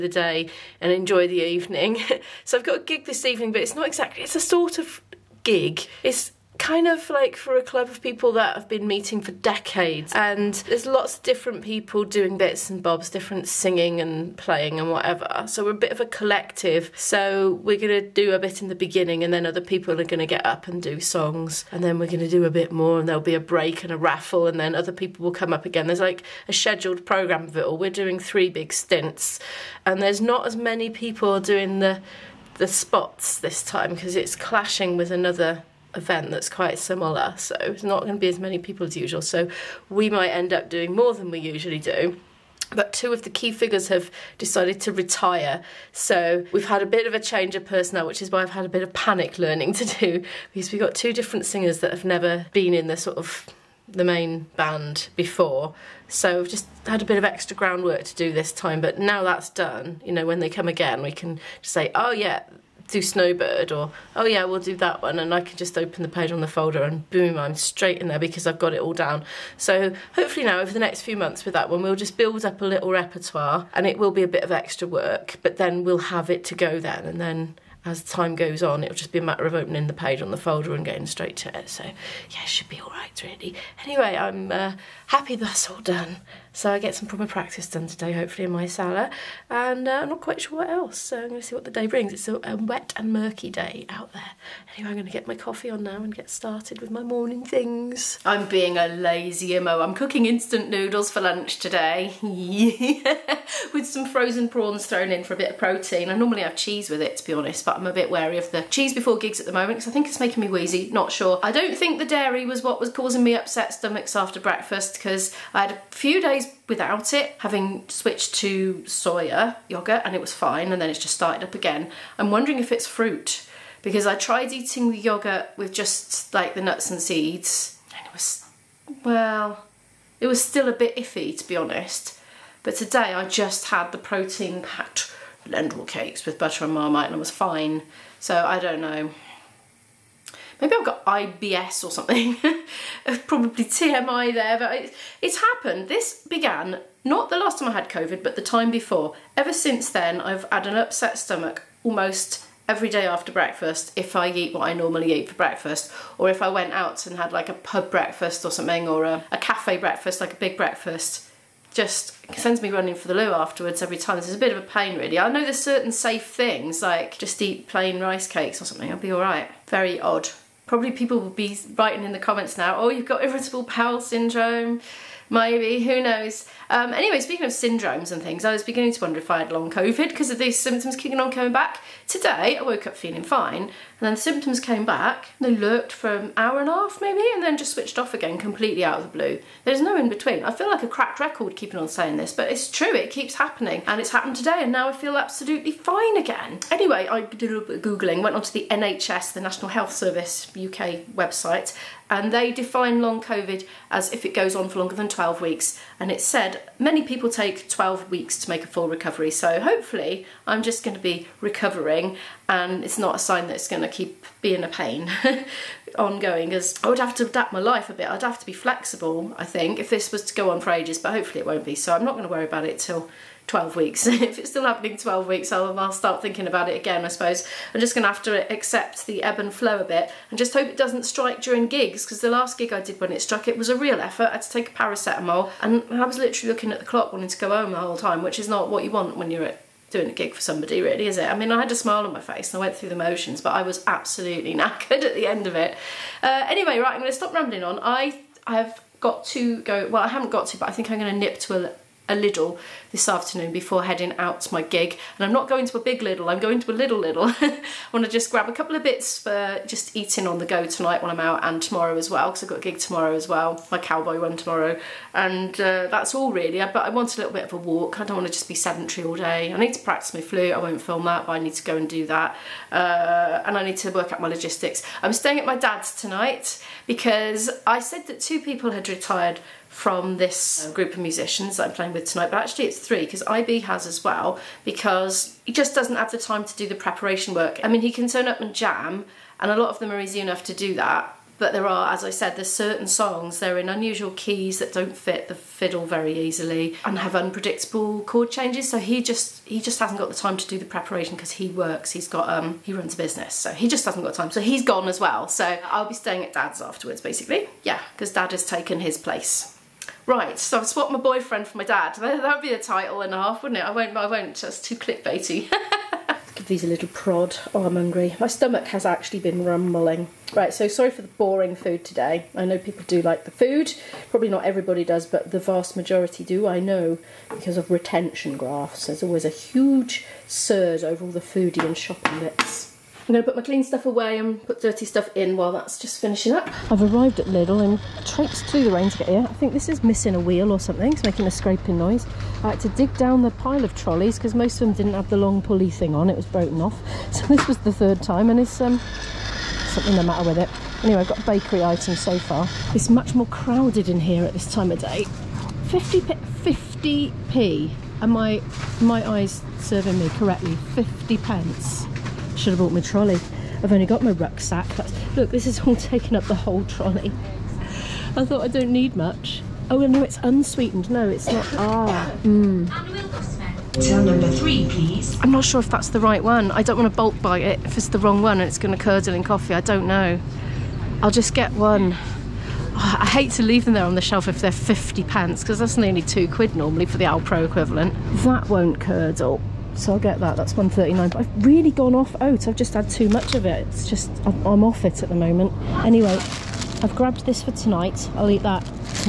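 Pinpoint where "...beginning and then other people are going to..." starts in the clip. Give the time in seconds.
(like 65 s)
18 s.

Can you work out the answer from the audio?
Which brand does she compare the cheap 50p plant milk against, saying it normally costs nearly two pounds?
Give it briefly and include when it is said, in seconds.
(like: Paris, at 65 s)
Alpro, at 387 s.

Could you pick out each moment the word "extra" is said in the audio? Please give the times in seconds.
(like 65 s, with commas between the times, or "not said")
57 s, 74 s.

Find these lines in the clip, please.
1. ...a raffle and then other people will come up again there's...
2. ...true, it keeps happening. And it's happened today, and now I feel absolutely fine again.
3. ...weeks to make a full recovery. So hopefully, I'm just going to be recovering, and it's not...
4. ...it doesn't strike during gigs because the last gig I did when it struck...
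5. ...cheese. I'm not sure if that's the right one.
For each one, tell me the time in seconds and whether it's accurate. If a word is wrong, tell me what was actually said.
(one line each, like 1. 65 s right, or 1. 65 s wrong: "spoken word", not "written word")
1. 23 s right
2. 192 s right
3. 208 s right
4. 230 s right
5. 374 s wrong: "please", not "cheese".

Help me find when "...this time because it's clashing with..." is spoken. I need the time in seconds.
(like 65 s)
33 s.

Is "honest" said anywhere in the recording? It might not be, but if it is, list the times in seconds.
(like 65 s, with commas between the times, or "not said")
107 s, 131 s.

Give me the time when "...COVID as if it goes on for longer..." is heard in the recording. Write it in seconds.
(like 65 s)
203 s.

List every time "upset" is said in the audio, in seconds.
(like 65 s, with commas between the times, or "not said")
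113 s, 150 s.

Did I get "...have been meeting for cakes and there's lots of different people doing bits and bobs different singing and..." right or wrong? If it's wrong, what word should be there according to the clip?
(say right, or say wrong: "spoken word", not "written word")
wrong: "decades", not "cakes".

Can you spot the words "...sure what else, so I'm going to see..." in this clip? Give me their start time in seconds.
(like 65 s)
90 s.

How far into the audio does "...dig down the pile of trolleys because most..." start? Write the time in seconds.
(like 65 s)
342 s.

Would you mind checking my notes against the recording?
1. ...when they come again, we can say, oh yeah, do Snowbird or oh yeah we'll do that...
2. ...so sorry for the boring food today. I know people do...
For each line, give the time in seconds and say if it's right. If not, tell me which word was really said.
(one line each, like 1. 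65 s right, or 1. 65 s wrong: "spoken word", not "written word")
1. 60 s right
2. 320 s right.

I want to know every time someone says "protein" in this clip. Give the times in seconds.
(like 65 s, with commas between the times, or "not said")
105 s, 133 s.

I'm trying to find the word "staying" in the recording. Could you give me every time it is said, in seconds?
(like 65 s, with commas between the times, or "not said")
275 s, 305 s.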